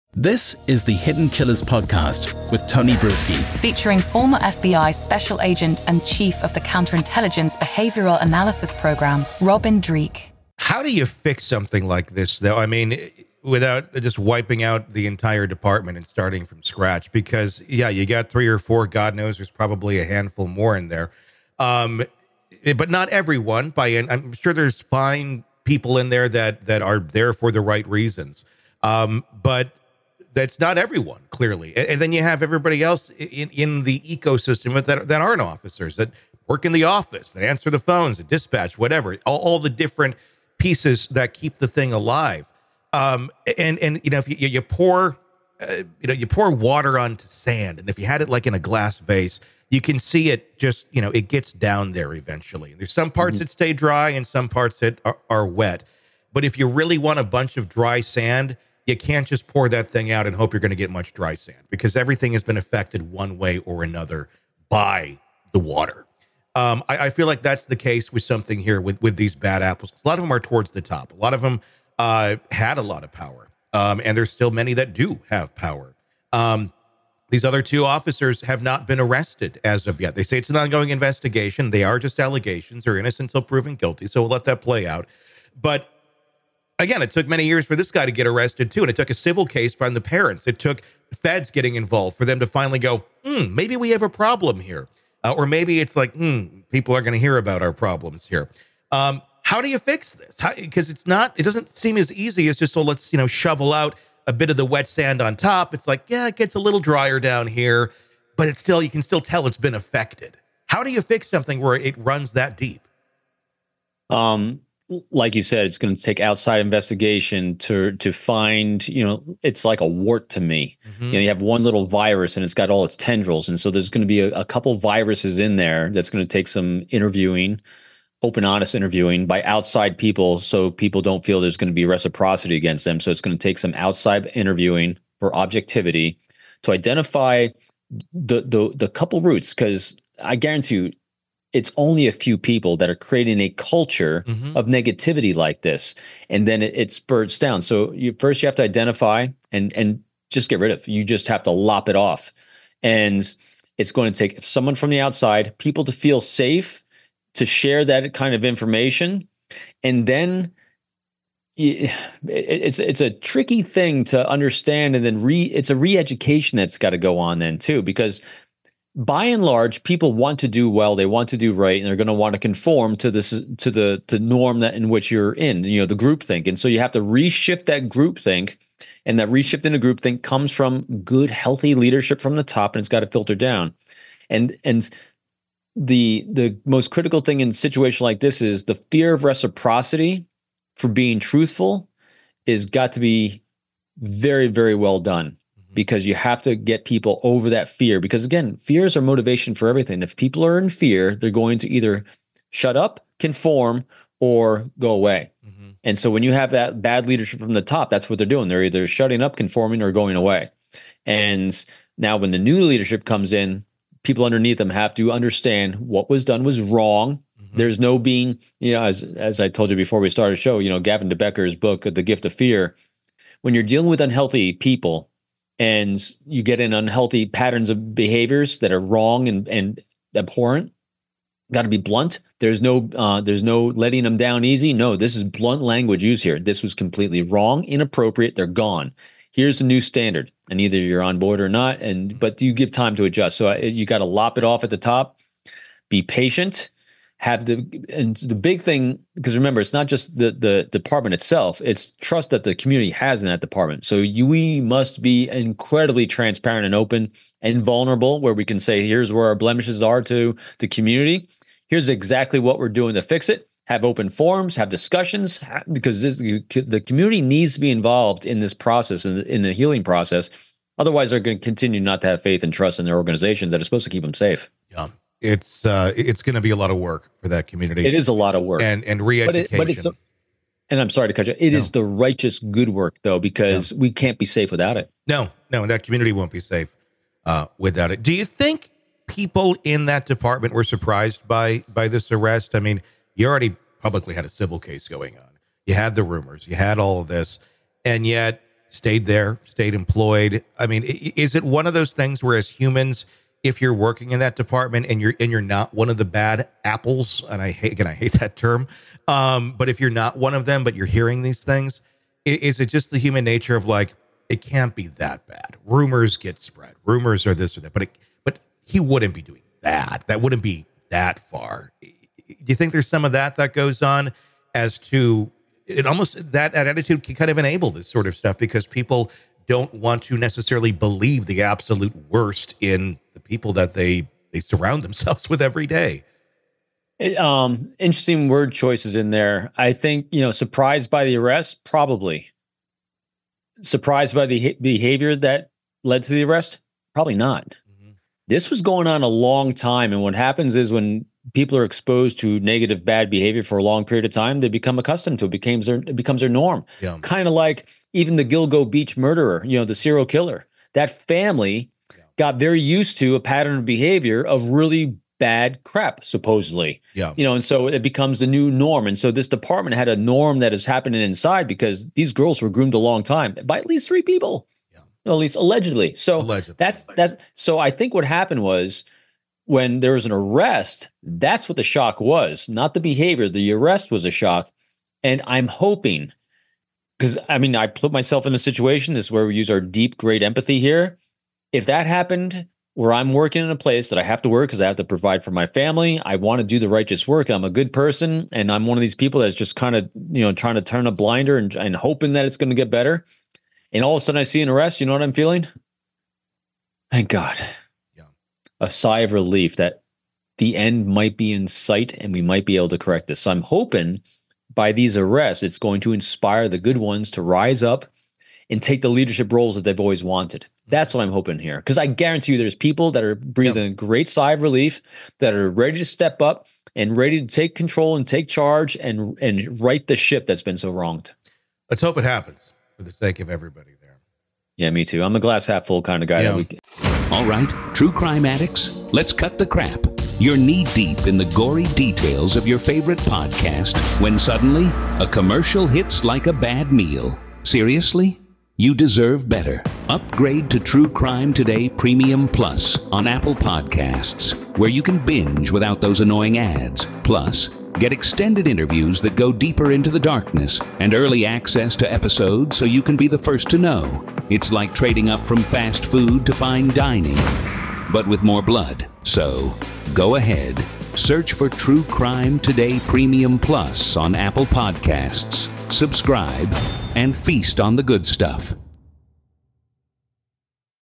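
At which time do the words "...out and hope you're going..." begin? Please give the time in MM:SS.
01:00.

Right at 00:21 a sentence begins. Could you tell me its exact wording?
Um, eh, but not everyone, by I'm sure there's fine people in there that, that are there for the right reasons.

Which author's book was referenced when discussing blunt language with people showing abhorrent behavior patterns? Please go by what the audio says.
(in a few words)
Gavin de Becker.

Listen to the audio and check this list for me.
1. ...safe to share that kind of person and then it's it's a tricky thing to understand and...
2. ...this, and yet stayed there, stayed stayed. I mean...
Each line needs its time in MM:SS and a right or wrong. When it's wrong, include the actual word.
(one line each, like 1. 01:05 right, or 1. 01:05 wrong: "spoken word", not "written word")
1. 02:36 wrong: "information", not "person"
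2. 04:57 wrong: "employed", not "stayed".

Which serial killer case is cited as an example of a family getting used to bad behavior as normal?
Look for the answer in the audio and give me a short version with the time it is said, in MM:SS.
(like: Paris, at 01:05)
Gilgo Beach, at 05:58.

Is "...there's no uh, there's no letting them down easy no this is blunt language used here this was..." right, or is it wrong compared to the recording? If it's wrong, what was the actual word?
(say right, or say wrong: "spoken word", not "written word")
right.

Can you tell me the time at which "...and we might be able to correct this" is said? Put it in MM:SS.
06:51.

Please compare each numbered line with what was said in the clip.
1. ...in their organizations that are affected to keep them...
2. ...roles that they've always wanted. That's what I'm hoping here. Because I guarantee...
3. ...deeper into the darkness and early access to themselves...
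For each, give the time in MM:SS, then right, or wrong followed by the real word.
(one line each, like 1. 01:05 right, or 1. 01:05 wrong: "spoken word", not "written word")
1. 04:32 wrong: "supposed", not "affected"
2. 06:59 right
3. 07:39 wrong: "episodes", not "themselves".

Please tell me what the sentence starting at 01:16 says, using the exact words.
Um, these other two officers have not been arrested as of yet.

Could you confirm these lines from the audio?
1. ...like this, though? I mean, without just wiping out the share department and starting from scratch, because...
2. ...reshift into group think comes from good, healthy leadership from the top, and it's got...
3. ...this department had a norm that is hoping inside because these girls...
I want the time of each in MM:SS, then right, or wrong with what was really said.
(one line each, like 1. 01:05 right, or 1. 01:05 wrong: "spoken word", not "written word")
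1. 00:11 wrong: "entire", not "share"
2. 02:59 right
3. 06:09 wrong: "happening", not "hoping".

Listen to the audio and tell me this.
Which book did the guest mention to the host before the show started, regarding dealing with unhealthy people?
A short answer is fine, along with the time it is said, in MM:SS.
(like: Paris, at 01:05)
The Gift of Fear, at 03:41.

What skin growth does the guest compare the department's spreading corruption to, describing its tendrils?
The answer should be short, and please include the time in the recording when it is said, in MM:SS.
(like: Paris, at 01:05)
A wart, at 01:59.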